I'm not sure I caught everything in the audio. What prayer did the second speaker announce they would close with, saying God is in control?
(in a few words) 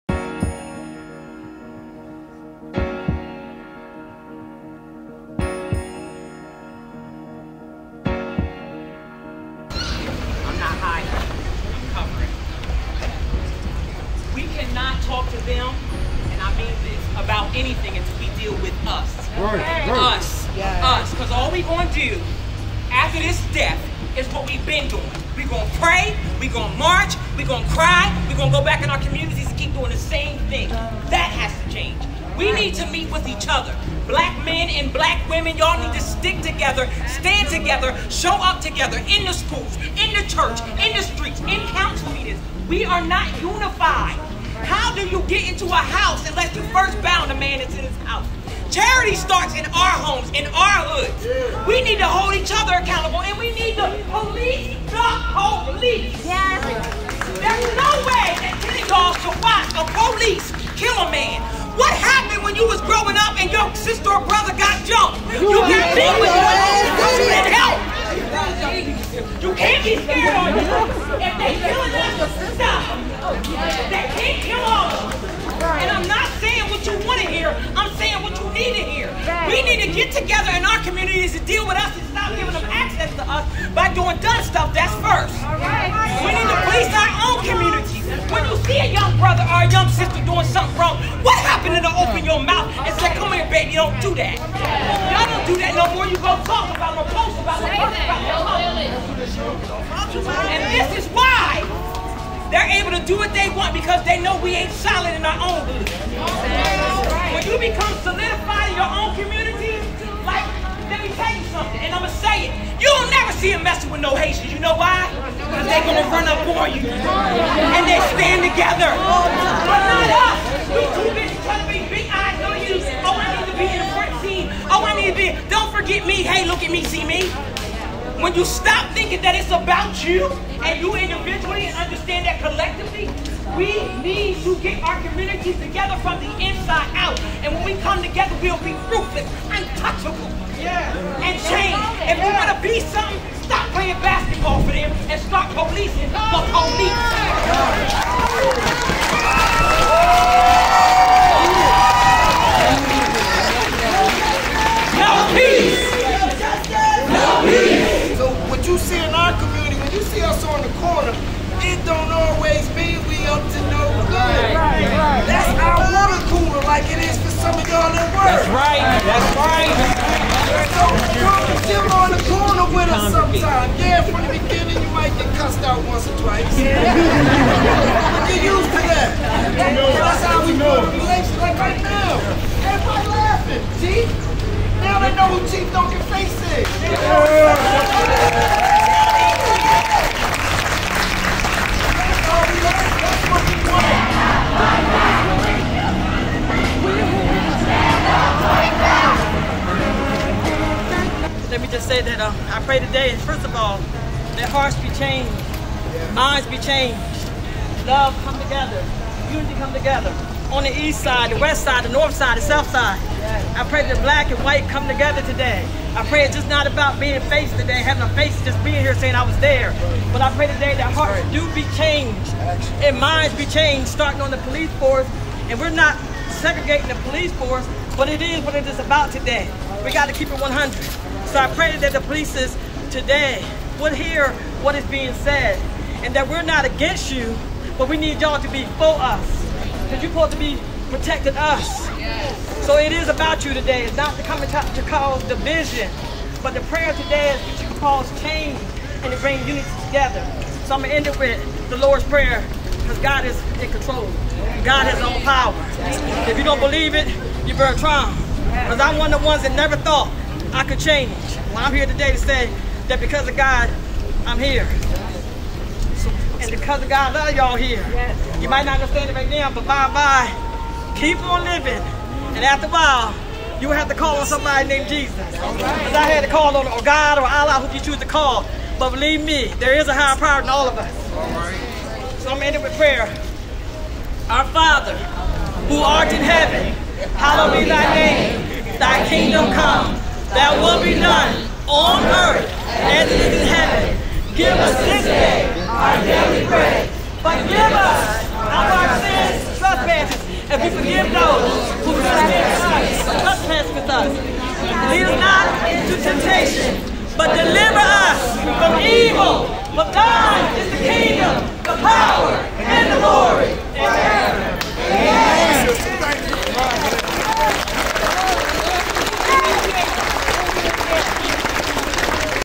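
The Lord's Prayer.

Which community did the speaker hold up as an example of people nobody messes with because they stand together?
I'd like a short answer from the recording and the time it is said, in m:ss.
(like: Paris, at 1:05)
Haitians, at 1:54.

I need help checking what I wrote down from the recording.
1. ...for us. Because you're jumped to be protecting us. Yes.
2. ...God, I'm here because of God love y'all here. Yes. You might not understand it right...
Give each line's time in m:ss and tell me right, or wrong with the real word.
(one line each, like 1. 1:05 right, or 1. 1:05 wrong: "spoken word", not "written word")
1. 3:58 wrong: "supposed", not "jumped"
2. 4:23 right.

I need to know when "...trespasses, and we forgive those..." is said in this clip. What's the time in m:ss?
4:59.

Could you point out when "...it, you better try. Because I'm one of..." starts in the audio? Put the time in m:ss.
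4:16.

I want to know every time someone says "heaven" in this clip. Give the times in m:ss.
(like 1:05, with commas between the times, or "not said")
4:46, 4:53.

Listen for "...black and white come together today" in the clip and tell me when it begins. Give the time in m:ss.
3:34.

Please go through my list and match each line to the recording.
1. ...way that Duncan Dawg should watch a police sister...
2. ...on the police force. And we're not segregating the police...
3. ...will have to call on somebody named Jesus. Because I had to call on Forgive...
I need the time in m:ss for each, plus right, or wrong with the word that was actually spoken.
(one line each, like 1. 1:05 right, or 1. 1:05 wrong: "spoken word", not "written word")
1. 0:58 wrong: "Kenny", not "Duncan"
2. 3:44 right
3. 4:33 wrong: "God", not "Forgive".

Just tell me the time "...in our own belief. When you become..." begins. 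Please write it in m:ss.
1:45.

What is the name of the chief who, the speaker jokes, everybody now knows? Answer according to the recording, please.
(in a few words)
Chief Duncan Face.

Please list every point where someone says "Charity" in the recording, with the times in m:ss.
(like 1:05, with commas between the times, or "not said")
0:48.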